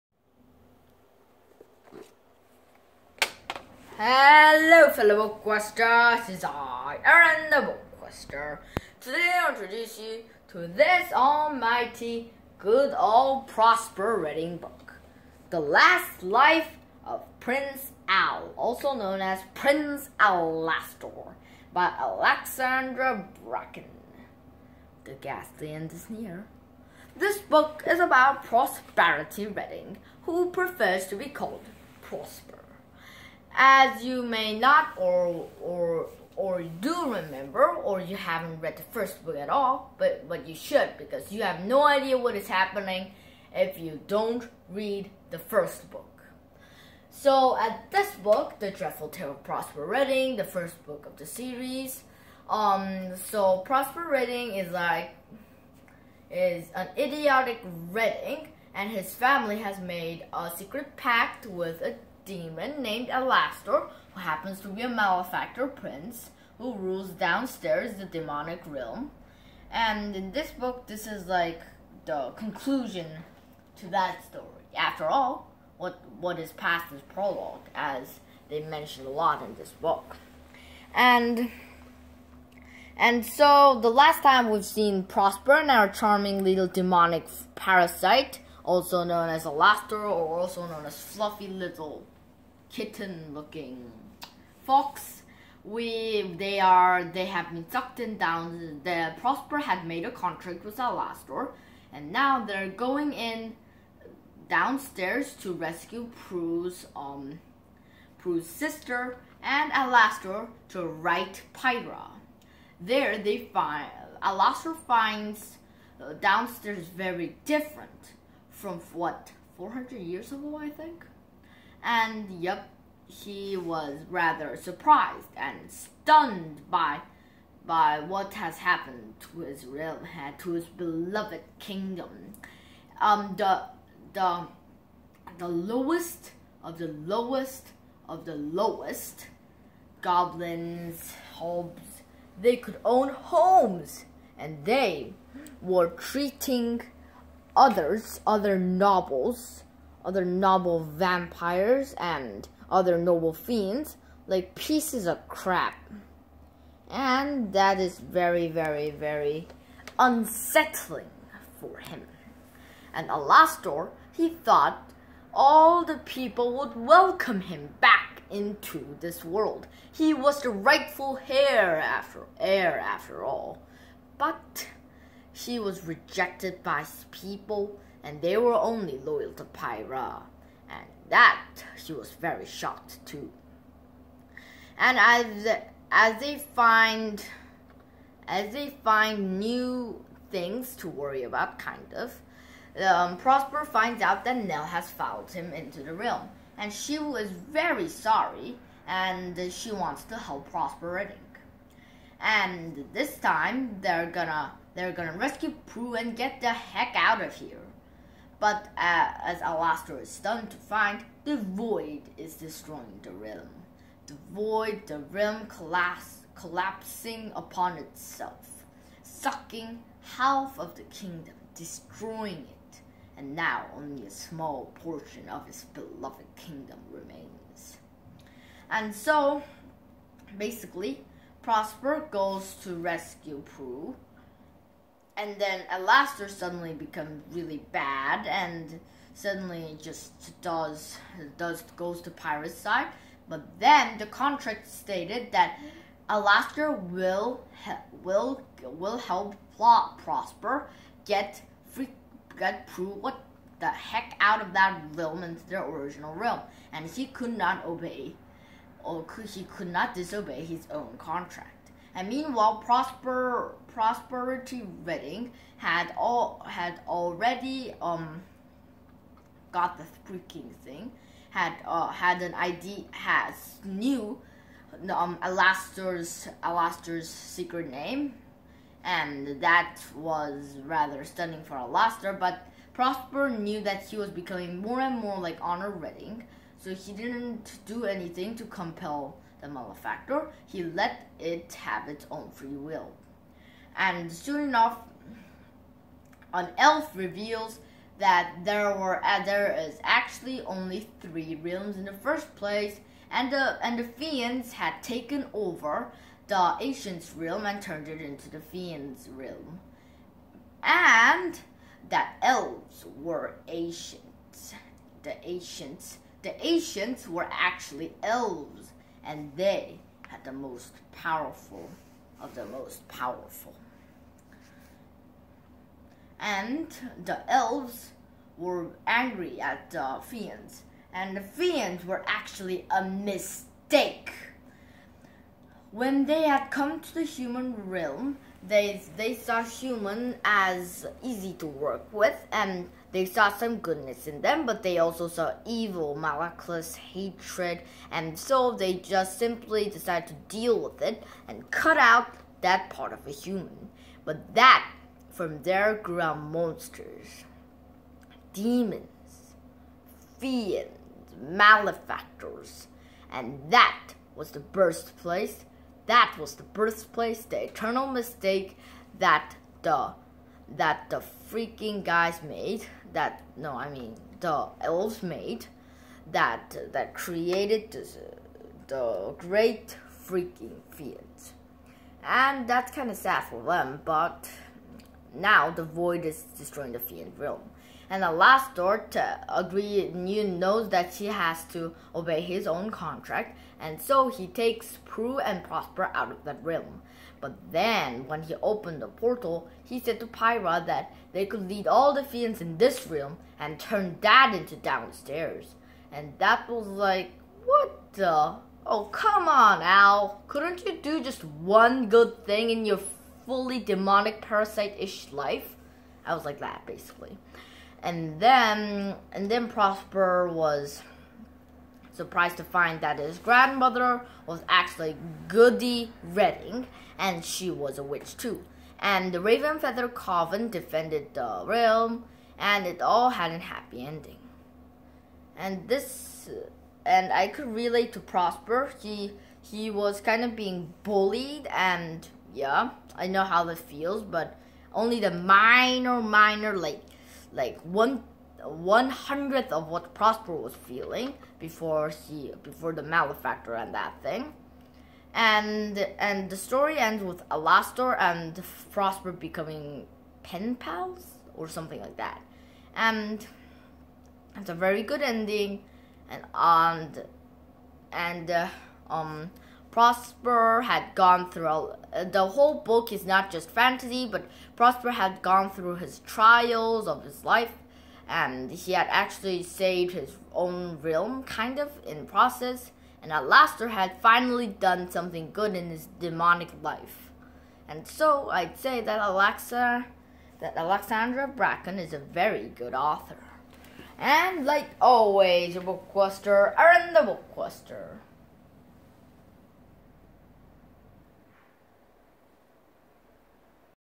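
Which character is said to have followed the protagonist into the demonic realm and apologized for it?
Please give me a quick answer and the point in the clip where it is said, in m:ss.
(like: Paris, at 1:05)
Nell, at 3:14.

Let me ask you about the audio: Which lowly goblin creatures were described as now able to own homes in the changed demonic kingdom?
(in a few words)
hobbs.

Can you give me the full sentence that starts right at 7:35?
And and the story ends with Alastor and Prosper becoming pen pals or something like that.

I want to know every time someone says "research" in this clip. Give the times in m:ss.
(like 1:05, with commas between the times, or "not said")
not said.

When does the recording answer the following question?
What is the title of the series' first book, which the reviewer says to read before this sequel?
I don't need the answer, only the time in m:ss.
0:48.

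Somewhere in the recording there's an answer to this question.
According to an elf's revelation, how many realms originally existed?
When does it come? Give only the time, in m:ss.
5:01.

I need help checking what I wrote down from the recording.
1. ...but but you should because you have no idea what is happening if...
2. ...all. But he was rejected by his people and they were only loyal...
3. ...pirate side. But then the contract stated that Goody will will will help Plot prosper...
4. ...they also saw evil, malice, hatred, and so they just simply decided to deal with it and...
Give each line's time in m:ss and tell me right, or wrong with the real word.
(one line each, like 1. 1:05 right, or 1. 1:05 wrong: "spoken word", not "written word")
1. 0:39 right
2. 2:53 right
3. 4:02 wrong: "Alastor", not "Goody"
4. 5:44 right.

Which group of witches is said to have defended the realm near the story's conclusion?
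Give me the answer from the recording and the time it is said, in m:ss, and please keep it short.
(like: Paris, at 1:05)
the Ravenfeather Coven, at 7:09.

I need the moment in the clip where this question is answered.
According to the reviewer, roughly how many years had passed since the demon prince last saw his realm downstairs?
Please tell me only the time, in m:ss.
1:59.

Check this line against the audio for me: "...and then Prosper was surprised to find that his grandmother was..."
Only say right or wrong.
right.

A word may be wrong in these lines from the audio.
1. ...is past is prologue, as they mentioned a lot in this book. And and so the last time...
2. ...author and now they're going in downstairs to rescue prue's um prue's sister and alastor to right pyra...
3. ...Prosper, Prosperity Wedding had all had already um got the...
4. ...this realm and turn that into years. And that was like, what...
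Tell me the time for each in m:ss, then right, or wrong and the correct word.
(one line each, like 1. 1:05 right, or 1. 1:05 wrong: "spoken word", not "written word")
1. 1:16 right
2. 1:40 wrong: "alastor", not "author"
3. 4:22 right
4. 6:42 wrong: "downstairs", not "years".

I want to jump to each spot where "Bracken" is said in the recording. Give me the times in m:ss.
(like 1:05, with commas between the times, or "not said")
0:23, 8:11.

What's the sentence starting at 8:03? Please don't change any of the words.
And at last, had finally done something good in his demonic life.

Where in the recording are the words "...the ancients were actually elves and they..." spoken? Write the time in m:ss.
5:16.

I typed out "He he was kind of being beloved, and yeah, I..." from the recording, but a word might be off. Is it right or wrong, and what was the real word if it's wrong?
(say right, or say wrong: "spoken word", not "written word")
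wrong: "bullied", not "beloved".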